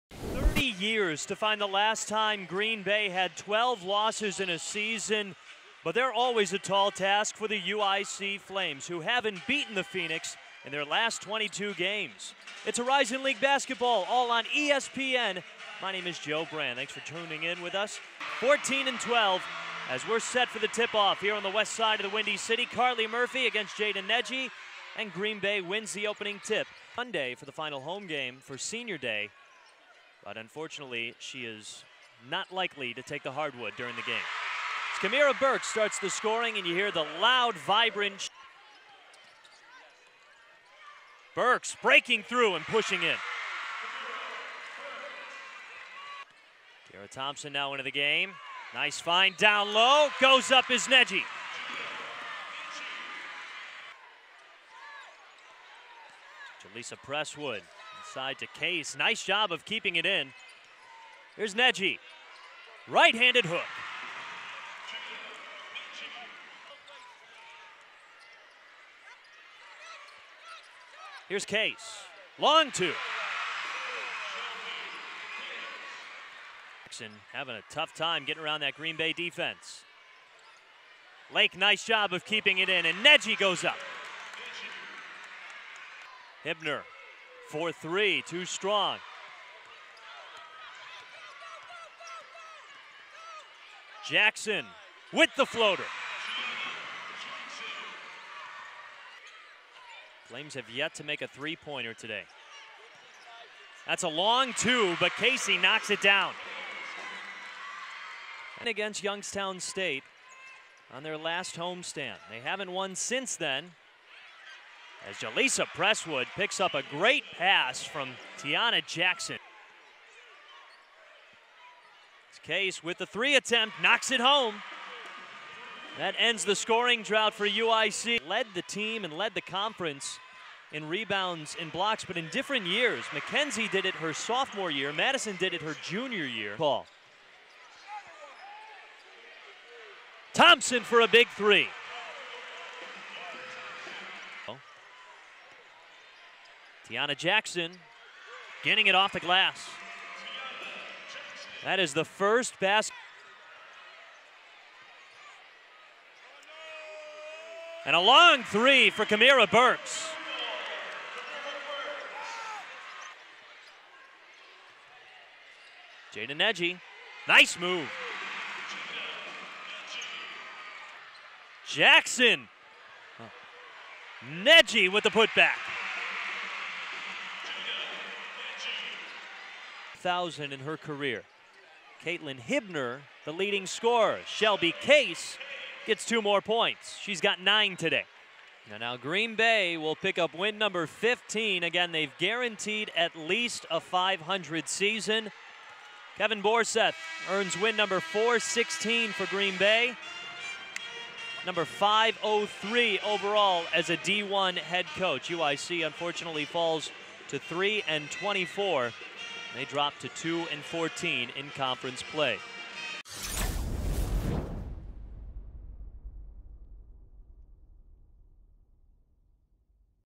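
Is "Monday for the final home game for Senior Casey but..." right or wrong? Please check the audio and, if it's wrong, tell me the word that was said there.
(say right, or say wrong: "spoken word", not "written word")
wrong: "Day", not "Casey".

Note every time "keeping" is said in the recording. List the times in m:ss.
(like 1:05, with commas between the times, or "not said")
0:59, 1:22.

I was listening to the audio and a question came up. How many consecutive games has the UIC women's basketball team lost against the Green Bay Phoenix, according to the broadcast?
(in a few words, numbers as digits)
22.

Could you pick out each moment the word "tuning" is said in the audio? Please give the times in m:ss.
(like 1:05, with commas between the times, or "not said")
0:17.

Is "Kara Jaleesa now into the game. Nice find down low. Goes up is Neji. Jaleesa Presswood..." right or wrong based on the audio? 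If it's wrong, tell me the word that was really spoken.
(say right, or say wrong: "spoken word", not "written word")
wrong: "Thompson", not "Jaleesa".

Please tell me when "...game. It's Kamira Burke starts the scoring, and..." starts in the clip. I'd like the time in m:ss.
0:34.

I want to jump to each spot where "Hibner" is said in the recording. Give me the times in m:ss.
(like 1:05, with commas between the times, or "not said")
1:26, 3:02.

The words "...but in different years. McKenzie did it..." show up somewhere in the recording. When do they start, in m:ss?
2:12.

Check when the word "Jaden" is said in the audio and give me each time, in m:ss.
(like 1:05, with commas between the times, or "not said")
0:23, 2:46.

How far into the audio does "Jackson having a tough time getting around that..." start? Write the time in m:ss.
1:16.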